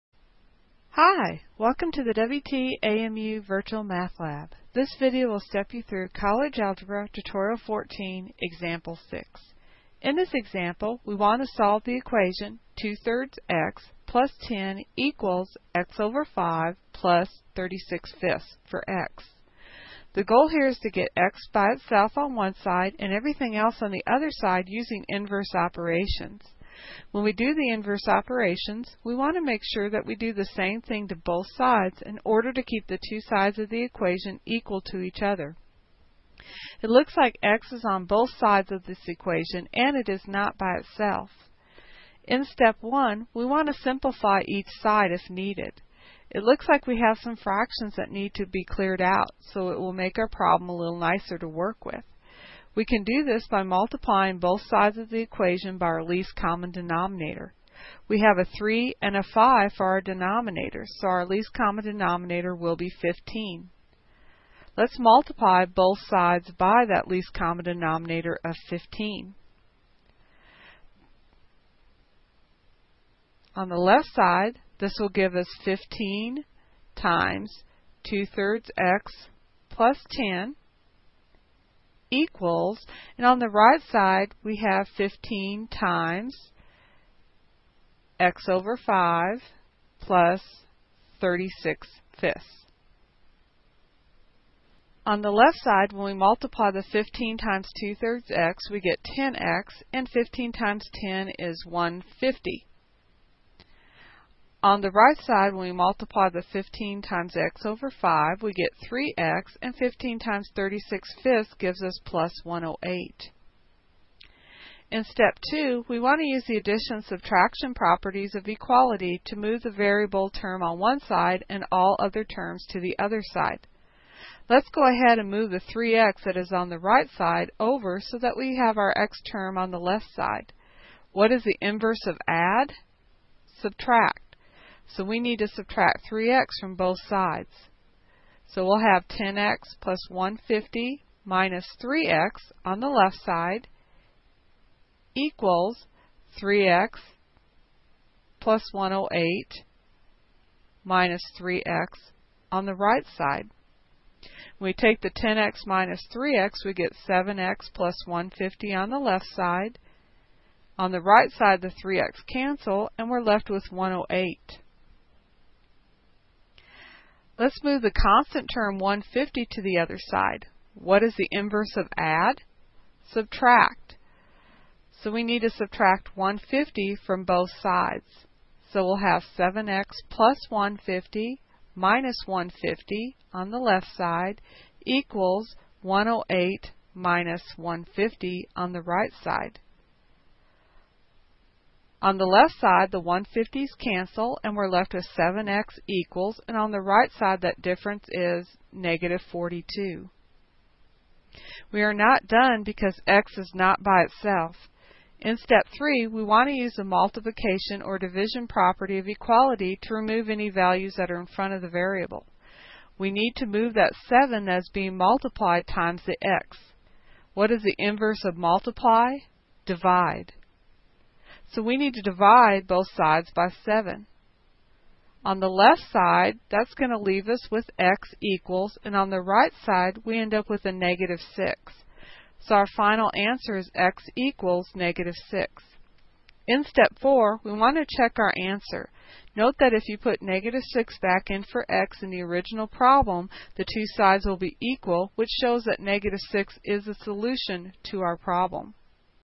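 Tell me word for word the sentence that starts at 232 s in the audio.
So our final answer is x equals negative 6.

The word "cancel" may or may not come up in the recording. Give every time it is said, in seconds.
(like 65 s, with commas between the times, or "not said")
162 s, 193 s.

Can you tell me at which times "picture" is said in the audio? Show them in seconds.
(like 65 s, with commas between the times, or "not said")
not said.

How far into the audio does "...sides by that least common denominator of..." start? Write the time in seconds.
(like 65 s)
65 s.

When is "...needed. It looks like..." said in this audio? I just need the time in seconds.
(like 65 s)
45 s.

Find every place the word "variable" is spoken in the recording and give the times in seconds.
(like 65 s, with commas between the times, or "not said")
119 s, 211 s.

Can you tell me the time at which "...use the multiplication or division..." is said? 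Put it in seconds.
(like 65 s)
206 s.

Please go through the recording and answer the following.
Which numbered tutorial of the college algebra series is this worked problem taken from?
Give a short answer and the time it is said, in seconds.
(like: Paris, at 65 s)
14, at 7 s.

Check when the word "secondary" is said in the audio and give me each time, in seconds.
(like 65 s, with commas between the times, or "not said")
not said.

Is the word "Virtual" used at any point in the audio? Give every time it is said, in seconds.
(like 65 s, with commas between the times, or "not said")
3 s.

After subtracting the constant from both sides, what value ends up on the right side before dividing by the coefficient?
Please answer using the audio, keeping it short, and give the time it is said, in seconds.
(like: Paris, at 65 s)
-42, at 198 s.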